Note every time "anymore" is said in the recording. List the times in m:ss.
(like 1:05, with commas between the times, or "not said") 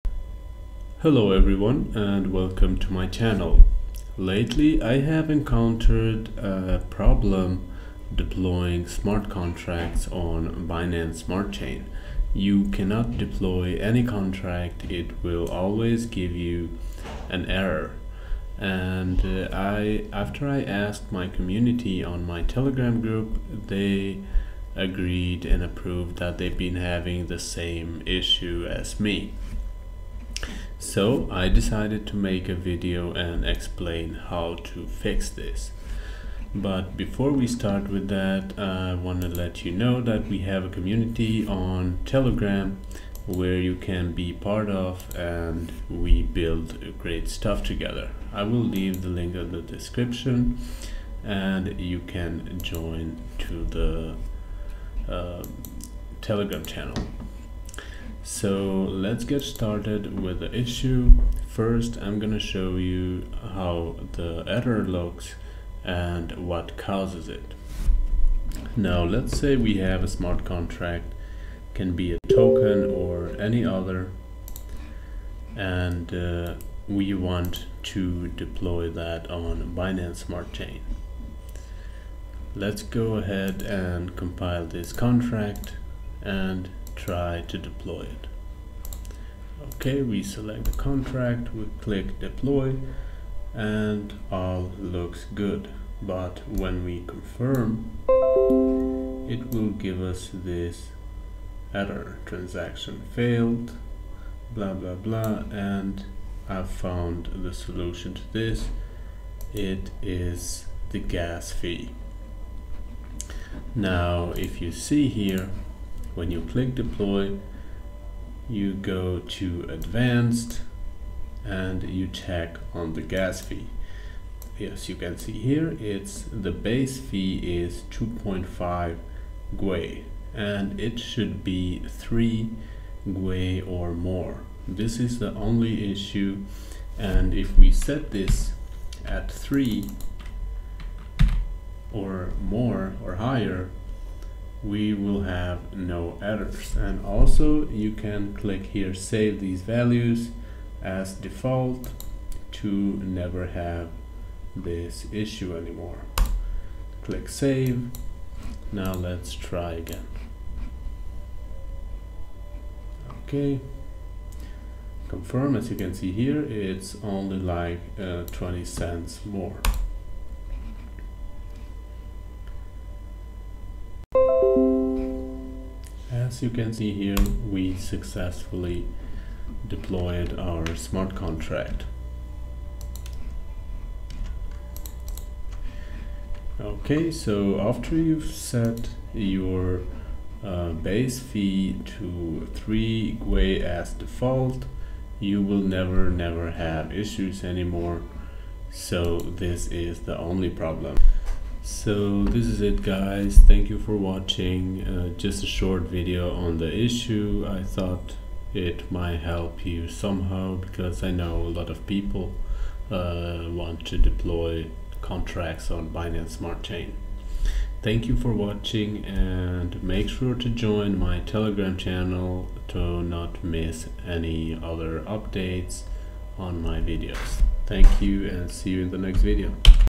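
2:35, 3:17.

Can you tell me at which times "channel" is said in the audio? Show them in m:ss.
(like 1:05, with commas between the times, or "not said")
0:03, 0:56, 3:41.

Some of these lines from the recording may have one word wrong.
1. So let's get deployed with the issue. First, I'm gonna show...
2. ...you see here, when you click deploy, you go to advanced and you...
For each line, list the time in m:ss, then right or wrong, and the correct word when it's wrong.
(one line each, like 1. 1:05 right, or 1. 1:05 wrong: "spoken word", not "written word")
1. 0:58 wrong: "started", not "deployed"
2. 1:54 right.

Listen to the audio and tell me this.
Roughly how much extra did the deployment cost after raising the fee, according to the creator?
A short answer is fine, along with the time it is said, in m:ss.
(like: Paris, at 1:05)
20 cents, at 2:48.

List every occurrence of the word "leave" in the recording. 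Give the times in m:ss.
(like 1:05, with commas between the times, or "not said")
0:48.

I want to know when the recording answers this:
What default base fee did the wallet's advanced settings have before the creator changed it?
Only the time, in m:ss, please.
2:07.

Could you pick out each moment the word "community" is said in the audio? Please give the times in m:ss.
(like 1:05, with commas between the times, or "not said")
0:21, 0:40.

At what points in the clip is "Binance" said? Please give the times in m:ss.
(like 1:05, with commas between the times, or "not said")
0:10, 1:19, 3:35.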